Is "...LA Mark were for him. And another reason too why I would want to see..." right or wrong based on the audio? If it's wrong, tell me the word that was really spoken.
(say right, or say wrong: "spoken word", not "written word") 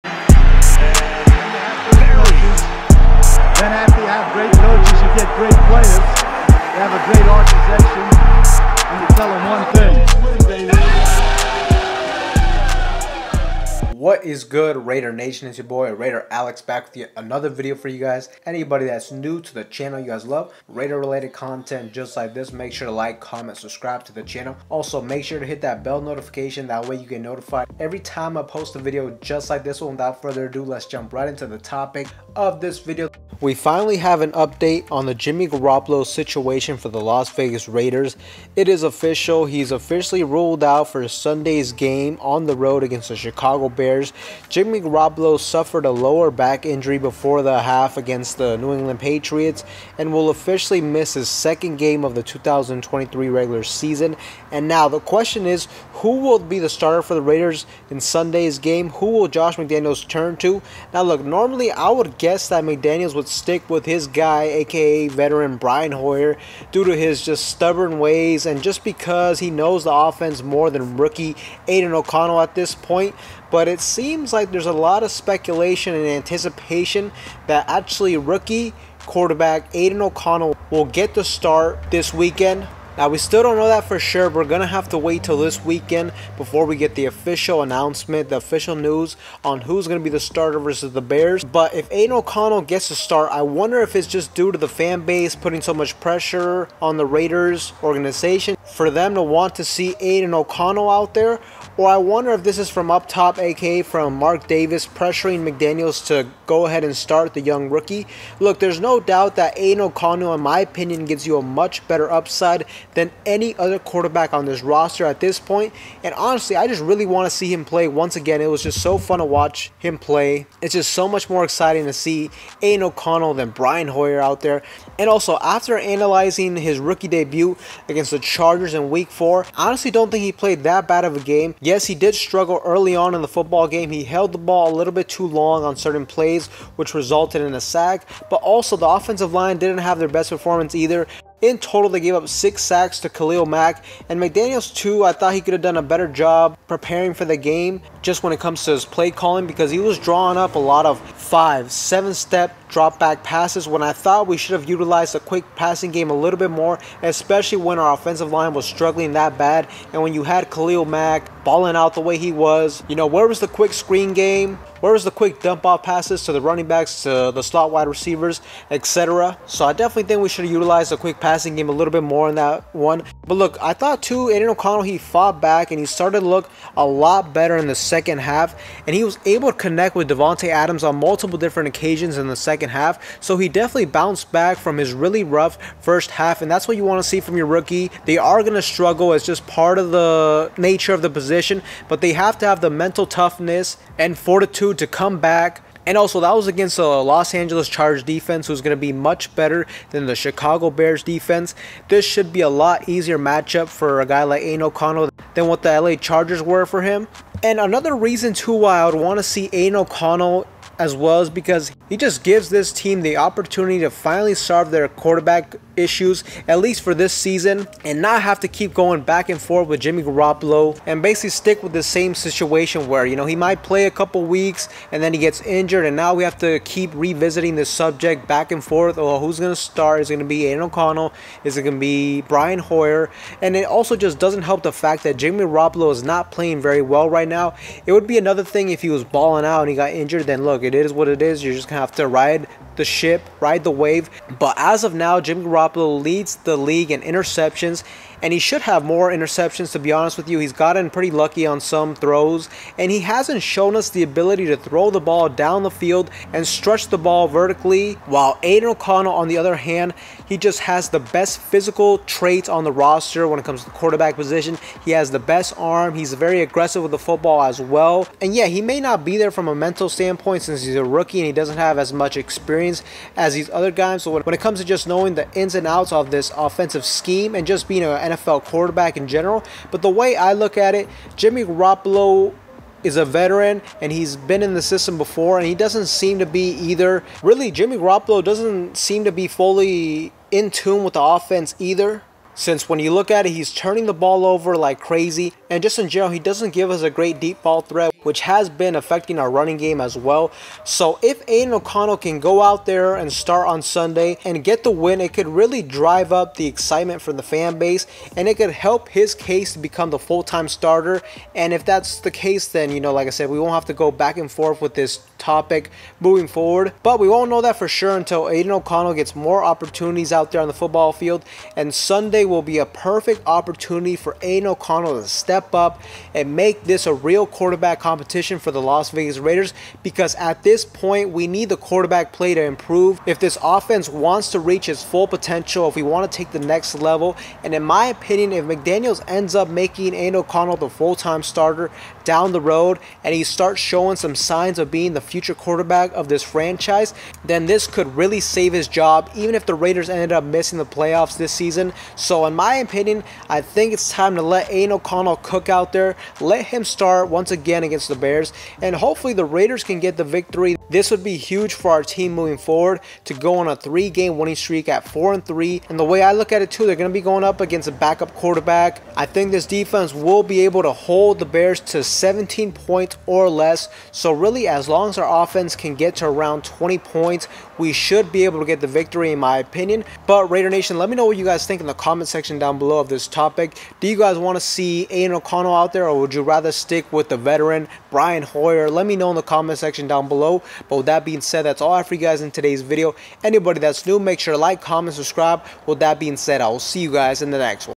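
wrong: "Chargers", not "Mark".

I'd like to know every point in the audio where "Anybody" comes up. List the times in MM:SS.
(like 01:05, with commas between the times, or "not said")
00:18, 06:33.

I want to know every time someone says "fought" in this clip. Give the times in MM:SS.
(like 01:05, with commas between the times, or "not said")
02:54.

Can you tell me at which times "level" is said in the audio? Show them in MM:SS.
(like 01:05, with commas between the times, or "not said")
05:36.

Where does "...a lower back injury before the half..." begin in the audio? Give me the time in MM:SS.
00:45.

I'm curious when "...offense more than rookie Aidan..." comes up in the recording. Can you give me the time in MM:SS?
01:09.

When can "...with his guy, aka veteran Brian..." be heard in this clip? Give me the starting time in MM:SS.
01:03.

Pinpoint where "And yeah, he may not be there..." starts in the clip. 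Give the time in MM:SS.
04:28.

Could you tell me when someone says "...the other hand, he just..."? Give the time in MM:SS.
04:19.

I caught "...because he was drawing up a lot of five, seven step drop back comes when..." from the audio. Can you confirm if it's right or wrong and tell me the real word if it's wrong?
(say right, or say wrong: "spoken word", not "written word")
wrong: "passes", not "comes".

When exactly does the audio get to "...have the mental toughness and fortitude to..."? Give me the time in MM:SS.
03:12.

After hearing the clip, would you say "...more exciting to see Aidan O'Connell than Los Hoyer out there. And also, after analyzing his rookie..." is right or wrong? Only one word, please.
wrong.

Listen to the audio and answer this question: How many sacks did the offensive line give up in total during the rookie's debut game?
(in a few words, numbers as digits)
6.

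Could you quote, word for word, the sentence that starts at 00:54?
And now the question is who will be the starter for the Raiders in Sunday's game?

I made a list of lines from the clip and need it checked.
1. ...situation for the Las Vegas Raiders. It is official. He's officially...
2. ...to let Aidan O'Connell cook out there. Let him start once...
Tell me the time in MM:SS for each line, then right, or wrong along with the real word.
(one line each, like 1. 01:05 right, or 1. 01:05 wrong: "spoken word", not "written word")
1. 00:36 right
2. 05:54 right.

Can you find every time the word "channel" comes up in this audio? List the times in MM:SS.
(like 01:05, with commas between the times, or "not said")
00:19, 00:24.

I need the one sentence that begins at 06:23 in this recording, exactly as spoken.
Do you guys want to see Aidan O'Connell out there or would you rather stick with the veteran Brian Hoyer?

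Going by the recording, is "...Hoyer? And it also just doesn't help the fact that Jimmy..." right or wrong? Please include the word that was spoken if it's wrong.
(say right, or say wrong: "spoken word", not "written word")
right.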